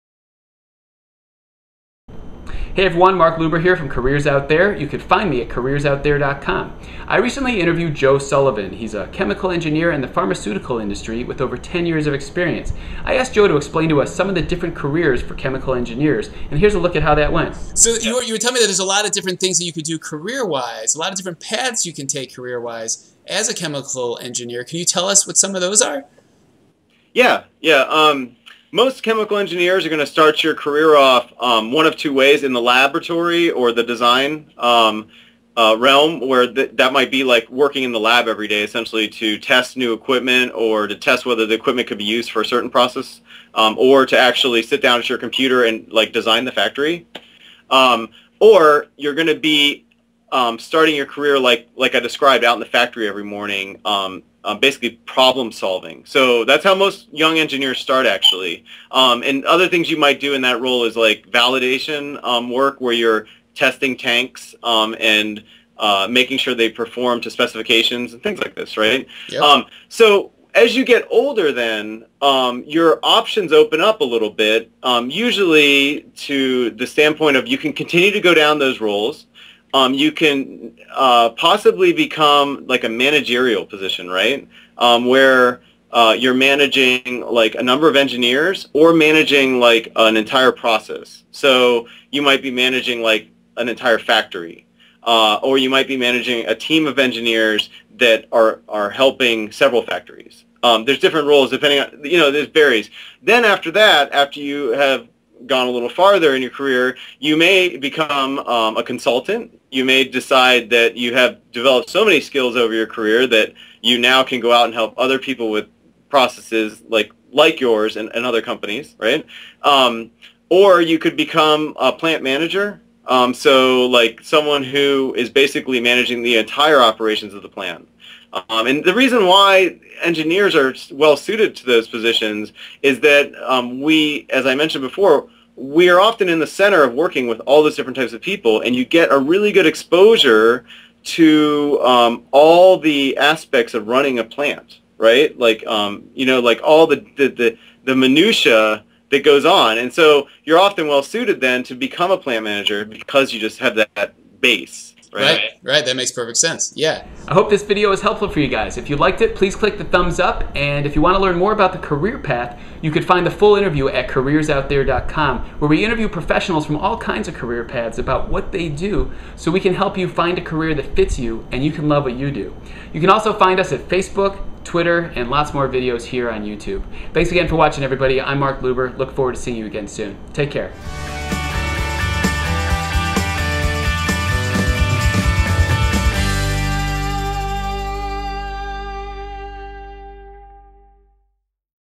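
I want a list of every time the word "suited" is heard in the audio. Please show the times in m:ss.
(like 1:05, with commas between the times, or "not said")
2:11, 2:31.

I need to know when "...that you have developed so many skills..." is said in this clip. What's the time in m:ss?
1:50.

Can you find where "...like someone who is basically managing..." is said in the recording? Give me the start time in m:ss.
2:03.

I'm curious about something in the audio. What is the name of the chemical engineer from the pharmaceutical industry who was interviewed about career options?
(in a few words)
Joe Sullivan.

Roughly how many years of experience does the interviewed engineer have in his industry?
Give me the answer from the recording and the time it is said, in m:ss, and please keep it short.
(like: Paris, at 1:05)
10, at 0:11.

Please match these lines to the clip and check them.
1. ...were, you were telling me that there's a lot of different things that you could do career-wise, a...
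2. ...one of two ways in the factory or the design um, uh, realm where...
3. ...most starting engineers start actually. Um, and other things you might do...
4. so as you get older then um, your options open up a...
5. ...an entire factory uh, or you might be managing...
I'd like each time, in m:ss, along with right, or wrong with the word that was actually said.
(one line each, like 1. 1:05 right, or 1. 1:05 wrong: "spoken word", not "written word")
1. 0:18 right
2. 0:31 wrong: "laboratory", not "factory"
3. 0:56 wrong: "young", not "starting"
4. 1:09 right
5. 1:33 right.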